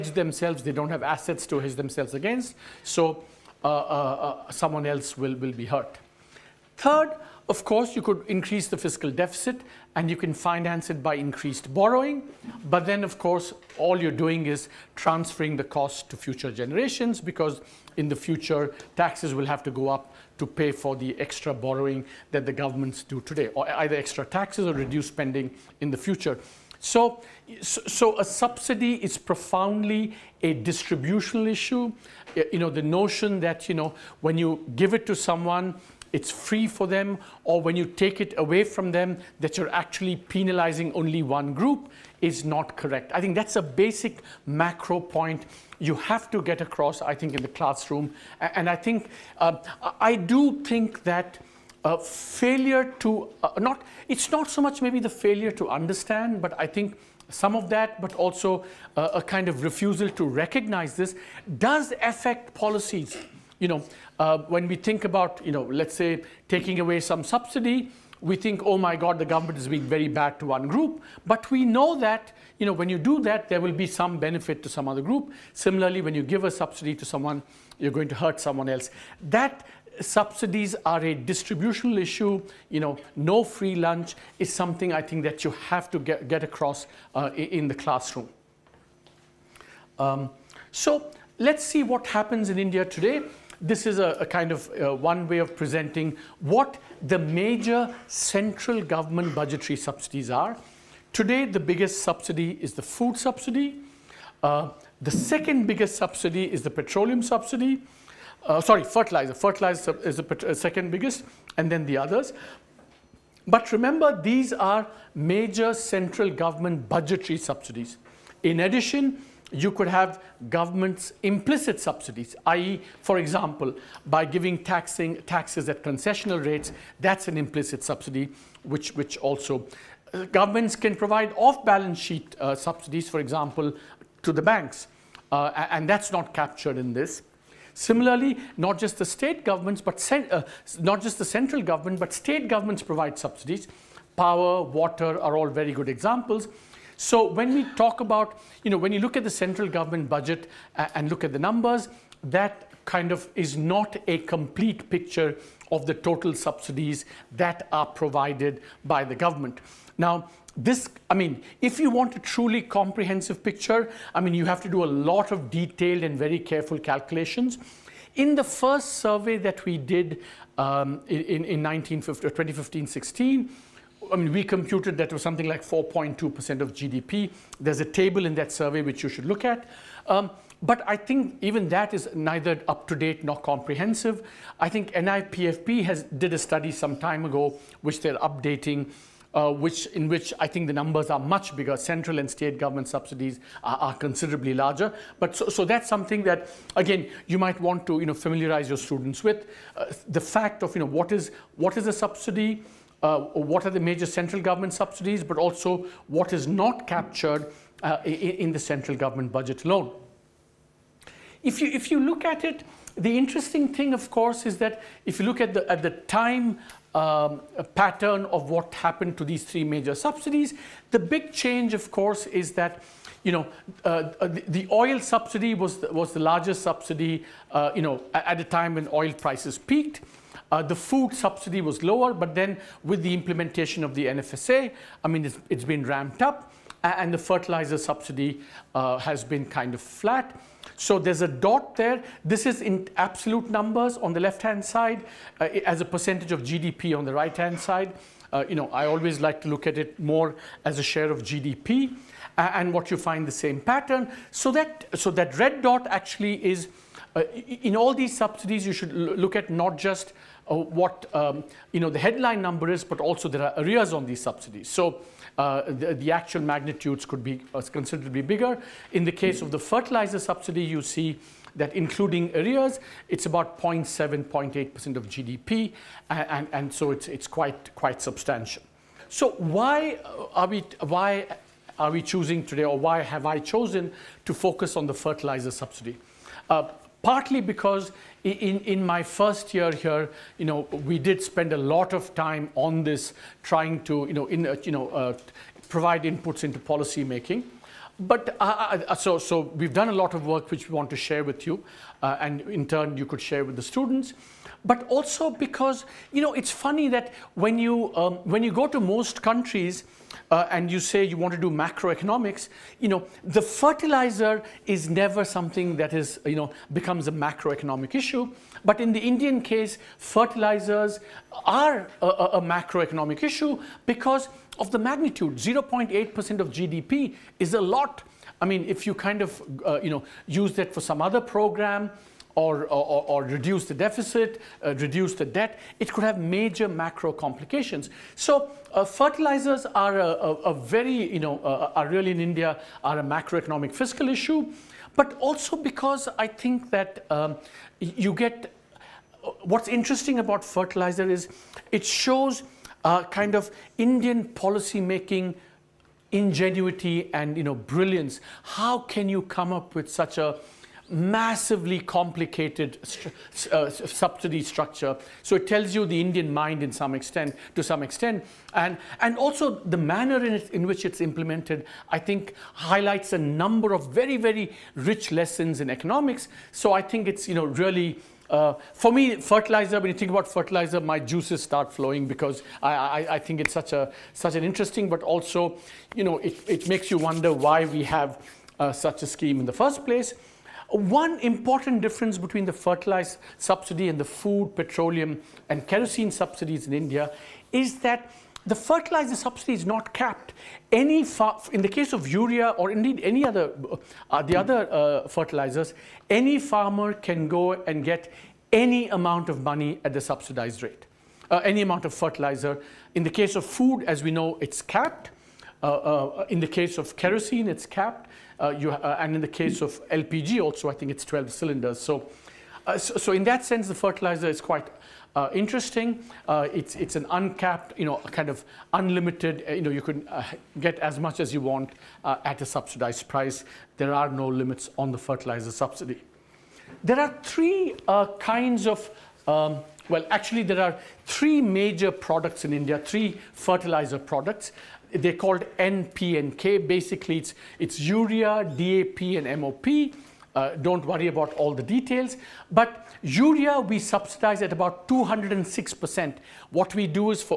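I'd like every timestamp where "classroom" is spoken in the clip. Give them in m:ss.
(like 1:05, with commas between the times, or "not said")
0:47, 1:27.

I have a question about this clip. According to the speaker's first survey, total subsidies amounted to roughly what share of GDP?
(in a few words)
4.2%.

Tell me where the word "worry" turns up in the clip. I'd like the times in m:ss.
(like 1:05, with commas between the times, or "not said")
7:30.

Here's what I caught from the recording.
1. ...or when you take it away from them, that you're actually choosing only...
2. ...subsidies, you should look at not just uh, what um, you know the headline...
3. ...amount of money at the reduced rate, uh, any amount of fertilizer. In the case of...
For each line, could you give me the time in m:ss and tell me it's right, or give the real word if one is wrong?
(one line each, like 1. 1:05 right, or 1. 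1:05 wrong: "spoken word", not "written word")
1. 0:37 wrong: "penalizing", not "choosing"
2. 4:18 right
3. 6:48 wrong: "subsidized", not "reduced".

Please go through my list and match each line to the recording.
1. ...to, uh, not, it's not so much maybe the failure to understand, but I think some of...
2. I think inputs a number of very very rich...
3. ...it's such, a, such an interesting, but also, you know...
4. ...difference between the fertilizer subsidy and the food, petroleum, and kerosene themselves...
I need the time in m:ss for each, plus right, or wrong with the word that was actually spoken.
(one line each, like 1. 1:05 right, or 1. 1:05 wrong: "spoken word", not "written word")
1. 0:52 right
2. 6:11 wrong: "highlights", not "inputs"
3. 6:23 right
4. 6:31 wrong: "subsidies", not "themselves".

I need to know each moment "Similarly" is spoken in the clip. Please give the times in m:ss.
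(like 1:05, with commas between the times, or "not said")
1:15, 2:17.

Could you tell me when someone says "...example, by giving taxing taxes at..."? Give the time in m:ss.
2:03.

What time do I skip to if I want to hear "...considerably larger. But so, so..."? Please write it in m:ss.
3:13.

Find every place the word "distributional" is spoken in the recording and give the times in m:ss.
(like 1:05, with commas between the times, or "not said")
0:30, 1:21.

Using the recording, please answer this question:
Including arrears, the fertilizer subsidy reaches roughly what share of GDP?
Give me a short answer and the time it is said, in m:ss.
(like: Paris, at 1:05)
0.7-0.8%, at 4:33.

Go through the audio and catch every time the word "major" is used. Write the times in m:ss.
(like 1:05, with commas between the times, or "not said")
1:37, 1:55, 3:23, 3:39, 5:36, 7:21.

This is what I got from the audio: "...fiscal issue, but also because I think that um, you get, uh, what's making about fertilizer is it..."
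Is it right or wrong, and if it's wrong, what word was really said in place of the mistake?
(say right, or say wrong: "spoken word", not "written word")
wrong: "interesting", not "making".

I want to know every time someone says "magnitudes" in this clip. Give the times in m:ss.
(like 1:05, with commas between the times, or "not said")
4:26, 5:24.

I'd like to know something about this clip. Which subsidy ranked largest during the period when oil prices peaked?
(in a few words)
oil subsidy.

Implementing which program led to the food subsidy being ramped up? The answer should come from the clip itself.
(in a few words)
NFSA.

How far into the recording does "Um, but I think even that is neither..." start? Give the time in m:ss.
3:00.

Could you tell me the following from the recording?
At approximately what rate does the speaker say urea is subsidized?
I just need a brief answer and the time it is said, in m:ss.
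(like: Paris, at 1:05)
206%, at 7:34.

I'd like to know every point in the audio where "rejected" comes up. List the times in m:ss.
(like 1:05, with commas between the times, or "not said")
not said.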